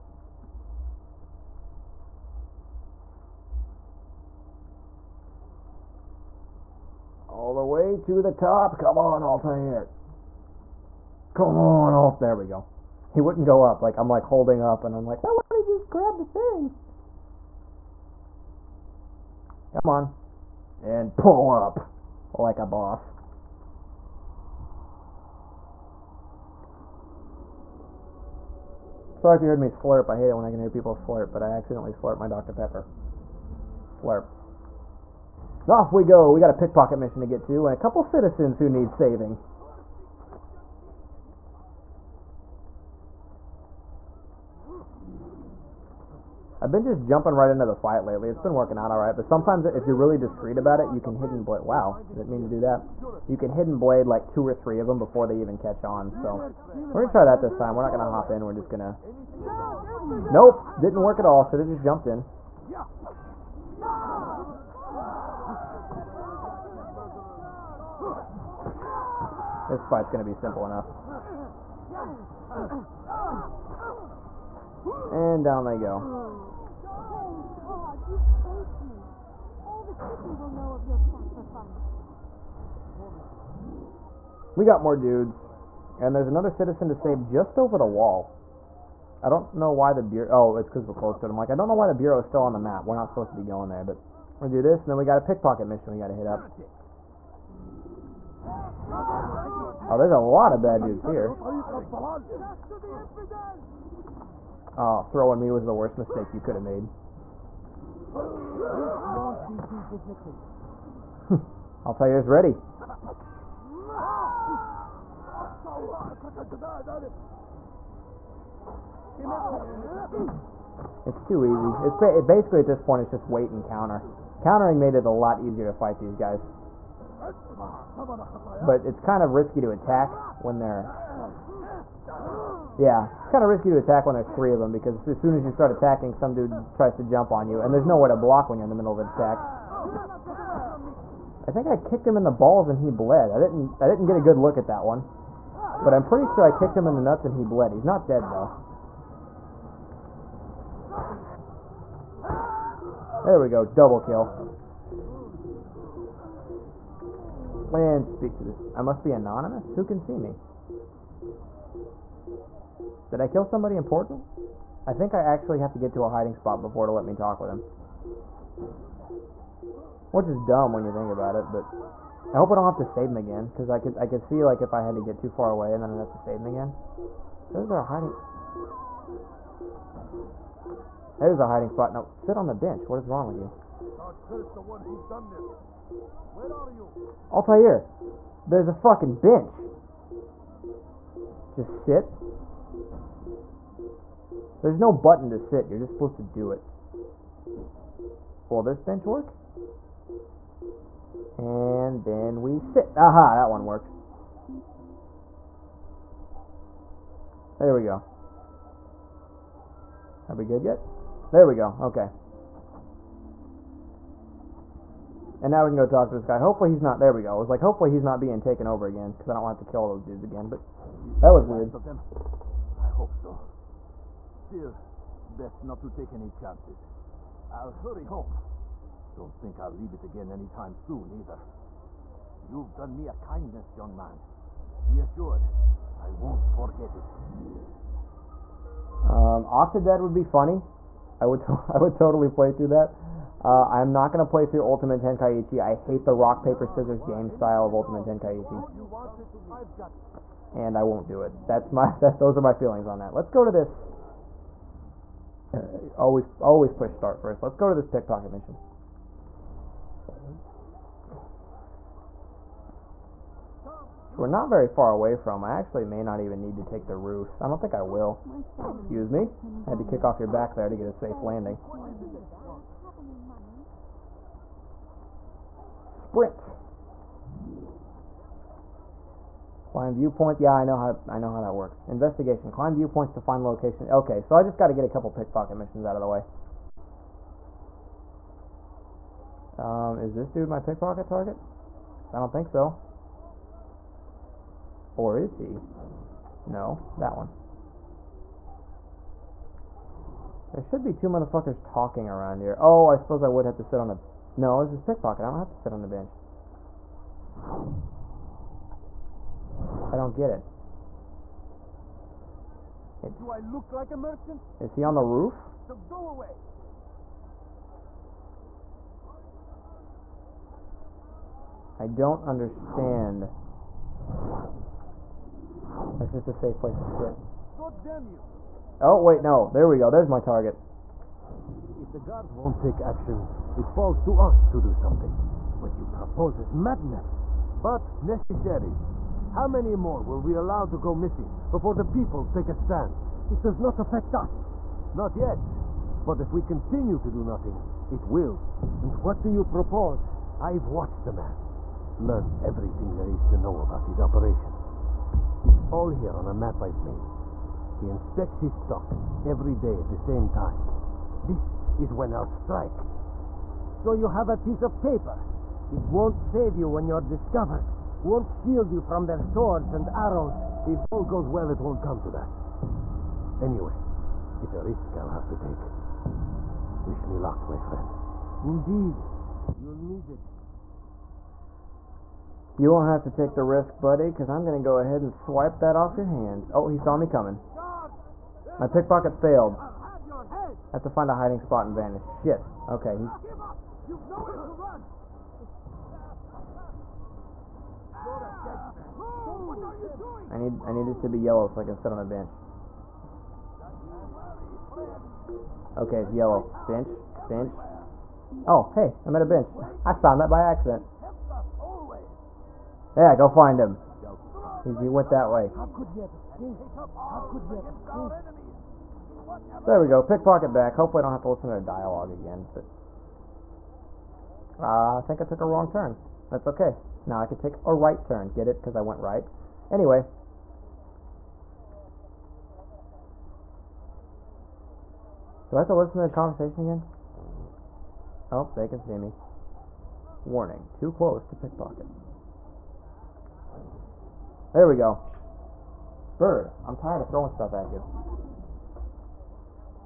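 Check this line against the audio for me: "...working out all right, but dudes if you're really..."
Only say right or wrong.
wrong.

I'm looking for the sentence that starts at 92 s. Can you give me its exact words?
We're not supposed to be going there, but...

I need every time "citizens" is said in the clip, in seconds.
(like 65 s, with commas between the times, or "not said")
38 s, 86 s.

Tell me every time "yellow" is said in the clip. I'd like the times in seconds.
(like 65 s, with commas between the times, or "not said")
401 s, 406 s.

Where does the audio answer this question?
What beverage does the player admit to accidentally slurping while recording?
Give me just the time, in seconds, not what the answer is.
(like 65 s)
32 s.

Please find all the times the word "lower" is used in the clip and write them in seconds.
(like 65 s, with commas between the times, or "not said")
not said.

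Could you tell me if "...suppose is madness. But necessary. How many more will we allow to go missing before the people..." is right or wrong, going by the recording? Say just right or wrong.
wrong.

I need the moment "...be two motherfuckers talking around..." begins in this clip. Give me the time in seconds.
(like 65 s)
300 s.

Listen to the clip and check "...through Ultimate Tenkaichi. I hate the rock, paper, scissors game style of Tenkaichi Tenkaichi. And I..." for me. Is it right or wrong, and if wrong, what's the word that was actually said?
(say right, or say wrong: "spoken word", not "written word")
wrong: "Ultimate", not "Tenkaichi".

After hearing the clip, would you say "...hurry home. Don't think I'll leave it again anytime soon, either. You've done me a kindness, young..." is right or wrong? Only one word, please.
right.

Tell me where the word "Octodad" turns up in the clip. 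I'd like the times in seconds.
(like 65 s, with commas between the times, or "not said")
239 s.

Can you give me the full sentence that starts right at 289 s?
Um, is this dude my pickpocket target?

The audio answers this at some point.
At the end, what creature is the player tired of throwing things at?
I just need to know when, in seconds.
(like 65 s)
446 s.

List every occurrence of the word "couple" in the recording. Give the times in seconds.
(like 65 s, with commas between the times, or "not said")
37 s, 284 s.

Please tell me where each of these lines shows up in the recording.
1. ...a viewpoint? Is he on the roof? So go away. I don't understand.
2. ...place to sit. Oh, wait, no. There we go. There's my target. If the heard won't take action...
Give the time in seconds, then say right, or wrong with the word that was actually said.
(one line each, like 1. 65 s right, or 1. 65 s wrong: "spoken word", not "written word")
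1. 313 s wrong: "merchant", not "viewpoint"
2. 326 s wrong: "guard", not "heard".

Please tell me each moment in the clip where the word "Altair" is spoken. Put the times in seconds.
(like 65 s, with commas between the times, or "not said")
9 s, 187 s.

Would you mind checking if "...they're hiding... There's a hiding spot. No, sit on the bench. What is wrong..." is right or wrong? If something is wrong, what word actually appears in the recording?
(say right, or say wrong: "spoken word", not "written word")
right.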